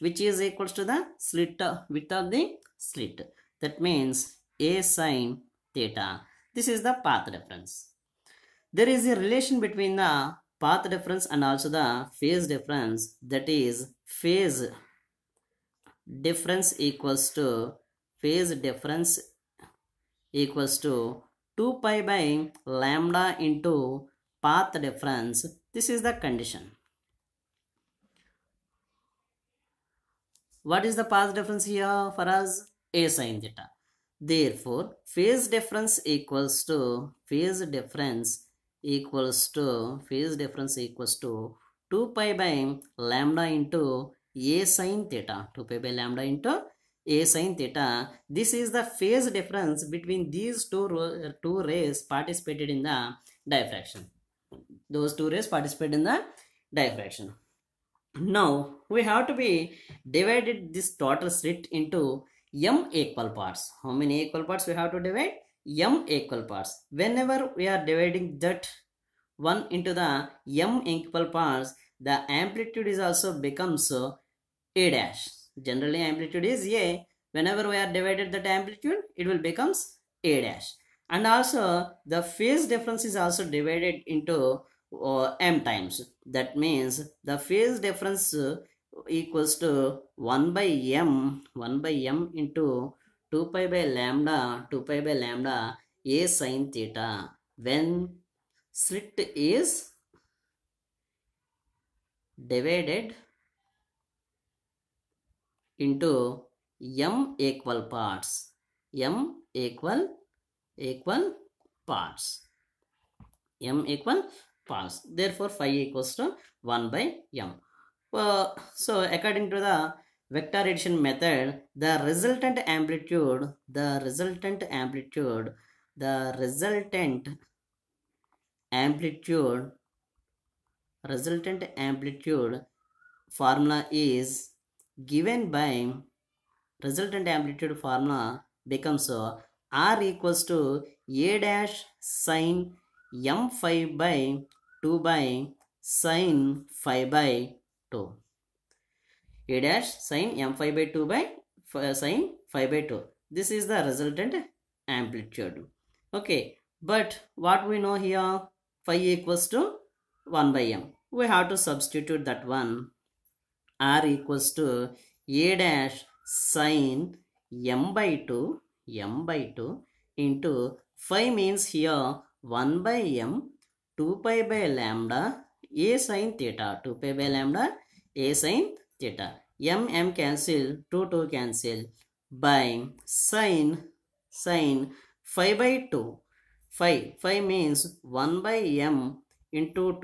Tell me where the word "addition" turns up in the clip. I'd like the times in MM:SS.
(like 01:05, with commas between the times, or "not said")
02:00.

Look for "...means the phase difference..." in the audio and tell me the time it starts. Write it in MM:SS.
01:26.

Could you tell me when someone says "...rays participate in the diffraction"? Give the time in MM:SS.
00:55.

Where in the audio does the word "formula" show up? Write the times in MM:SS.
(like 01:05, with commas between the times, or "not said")
02:13, 02:17.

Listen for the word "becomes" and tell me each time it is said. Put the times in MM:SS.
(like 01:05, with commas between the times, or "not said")
01:13, 01:19, 02:18.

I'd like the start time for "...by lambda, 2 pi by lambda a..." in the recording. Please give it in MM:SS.
01:33.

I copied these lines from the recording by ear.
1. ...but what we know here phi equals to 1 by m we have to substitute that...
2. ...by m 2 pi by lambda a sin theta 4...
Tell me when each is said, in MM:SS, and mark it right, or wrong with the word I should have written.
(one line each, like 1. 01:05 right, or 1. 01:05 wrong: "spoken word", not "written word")
1. 02:36 right
2. 02:52 wrong: "2", not "4".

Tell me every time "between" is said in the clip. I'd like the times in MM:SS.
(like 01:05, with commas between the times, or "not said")
00:09, 00:49.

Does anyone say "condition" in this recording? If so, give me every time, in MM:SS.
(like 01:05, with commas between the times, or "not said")
00:26.